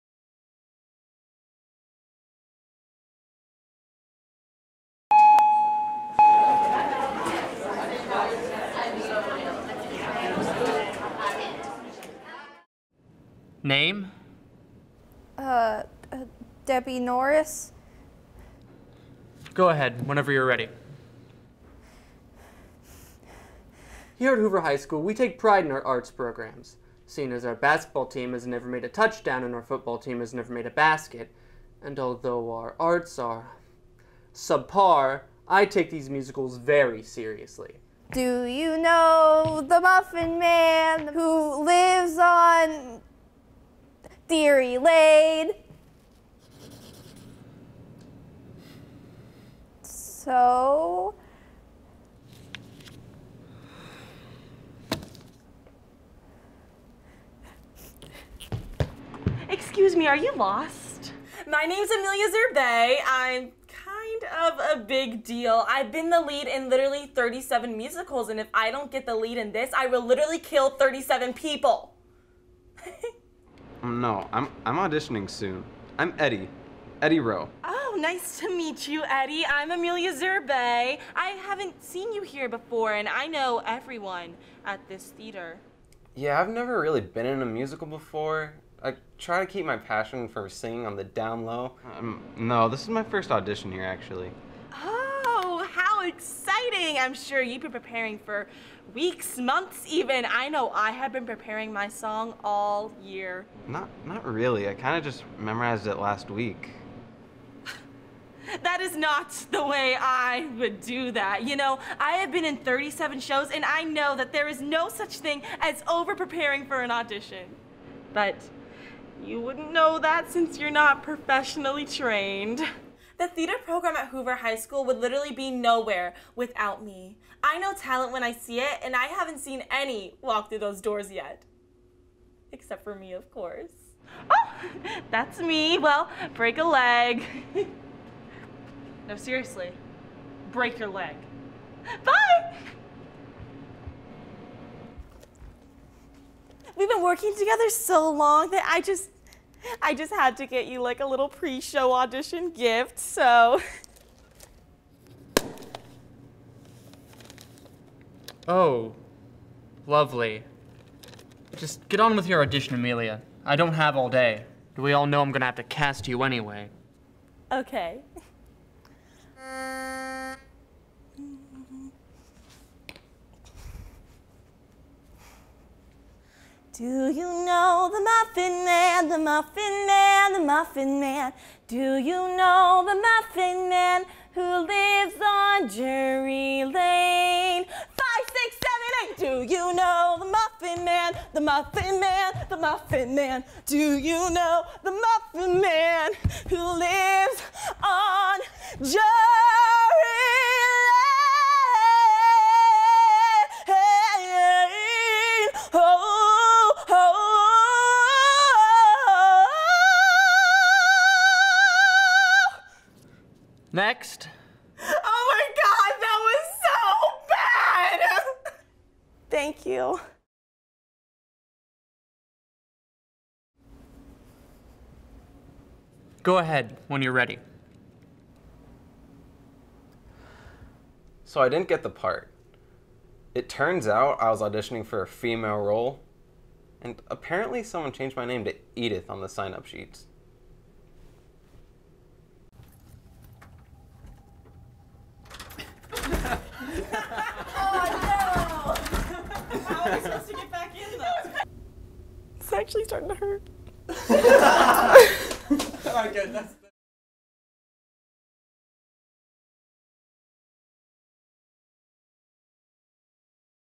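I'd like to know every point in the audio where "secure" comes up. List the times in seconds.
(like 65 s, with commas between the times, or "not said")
not said.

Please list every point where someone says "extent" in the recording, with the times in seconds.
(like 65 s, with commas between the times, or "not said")
not said.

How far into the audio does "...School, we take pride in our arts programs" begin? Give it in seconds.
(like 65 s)
24 s.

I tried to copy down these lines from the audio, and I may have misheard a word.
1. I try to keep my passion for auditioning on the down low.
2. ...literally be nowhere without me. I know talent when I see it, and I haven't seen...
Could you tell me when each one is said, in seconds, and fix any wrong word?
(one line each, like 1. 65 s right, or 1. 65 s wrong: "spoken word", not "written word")
1. 88 s wrong: "singing", not "auditioning"
2. 124 s right.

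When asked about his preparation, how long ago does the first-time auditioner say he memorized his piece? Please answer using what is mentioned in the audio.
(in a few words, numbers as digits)
last week.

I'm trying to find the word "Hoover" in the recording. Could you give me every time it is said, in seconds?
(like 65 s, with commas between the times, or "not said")
24 s, 124 s.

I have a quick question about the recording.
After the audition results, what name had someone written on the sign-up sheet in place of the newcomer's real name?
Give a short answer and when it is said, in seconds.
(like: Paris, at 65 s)
Edith, at 238 s.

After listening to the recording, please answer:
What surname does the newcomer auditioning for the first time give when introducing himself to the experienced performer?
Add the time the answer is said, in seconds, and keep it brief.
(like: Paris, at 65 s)
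Rowe, at 77 s.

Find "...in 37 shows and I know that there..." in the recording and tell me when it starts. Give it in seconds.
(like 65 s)
112 s.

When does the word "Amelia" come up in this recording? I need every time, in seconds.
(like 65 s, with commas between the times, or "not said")
61 s, 79 s, 162 s.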